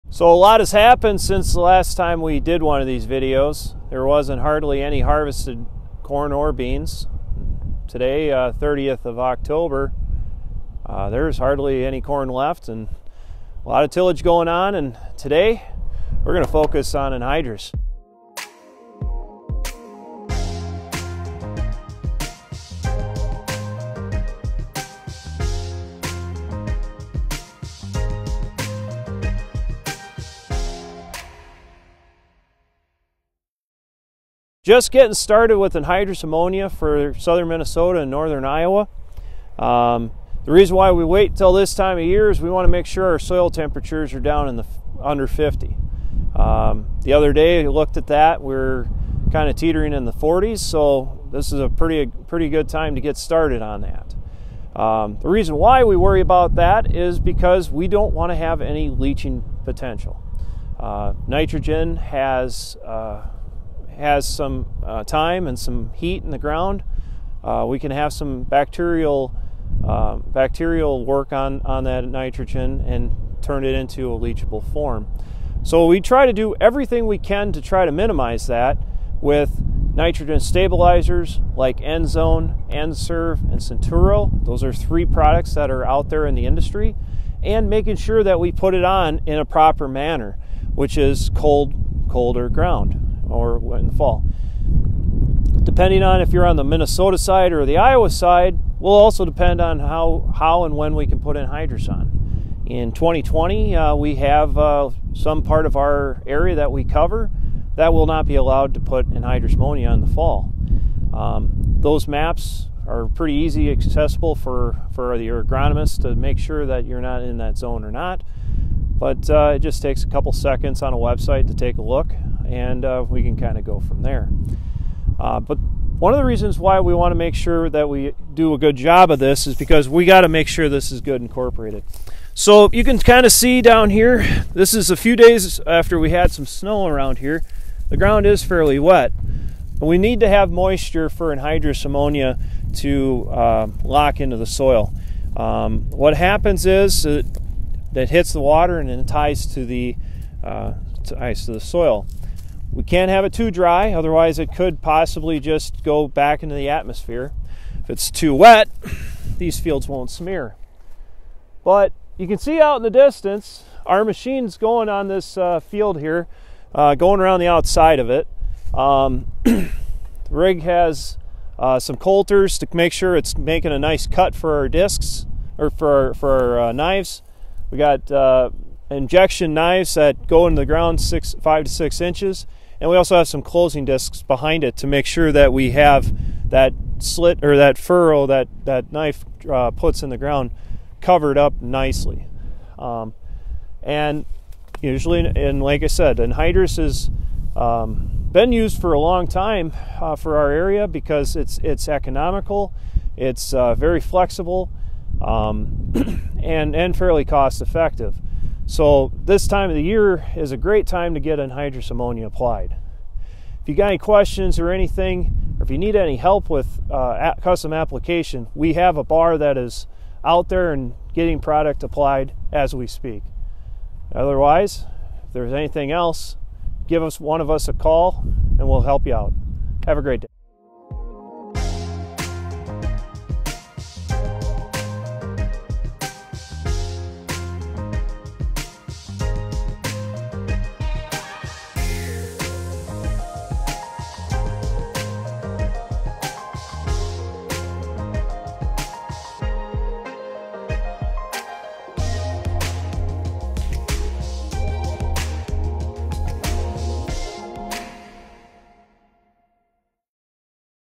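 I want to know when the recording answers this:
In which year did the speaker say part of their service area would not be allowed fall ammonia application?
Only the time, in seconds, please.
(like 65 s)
102 s.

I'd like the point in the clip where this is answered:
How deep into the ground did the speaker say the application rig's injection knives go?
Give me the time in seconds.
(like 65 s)
181 s.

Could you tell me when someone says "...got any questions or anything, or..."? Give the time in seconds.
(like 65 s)
213 s.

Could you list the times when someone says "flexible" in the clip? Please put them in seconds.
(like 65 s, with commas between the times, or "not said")
204 s.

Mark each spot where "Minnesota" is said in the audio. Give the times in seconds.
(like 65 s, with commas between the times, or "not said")
37 s, 96 s.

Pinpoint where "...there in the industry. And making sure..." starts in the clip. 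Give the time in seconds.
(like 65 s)
86 s.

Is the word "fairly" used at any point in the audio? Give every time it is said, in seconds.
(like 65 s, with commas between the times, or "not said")
138 s, 206 s.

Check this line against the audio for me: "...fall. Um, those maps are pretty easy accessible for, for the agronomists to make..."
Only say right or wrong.
right.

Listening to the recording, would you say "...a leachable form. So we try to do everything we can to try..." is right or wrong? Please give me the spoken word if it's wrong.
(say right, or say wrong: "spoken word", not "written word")
right.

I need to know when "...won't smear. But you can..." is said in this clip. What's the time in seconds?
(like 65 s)
159 s.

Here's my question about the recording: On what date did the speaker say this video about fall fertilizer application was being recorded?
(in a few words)
October 30.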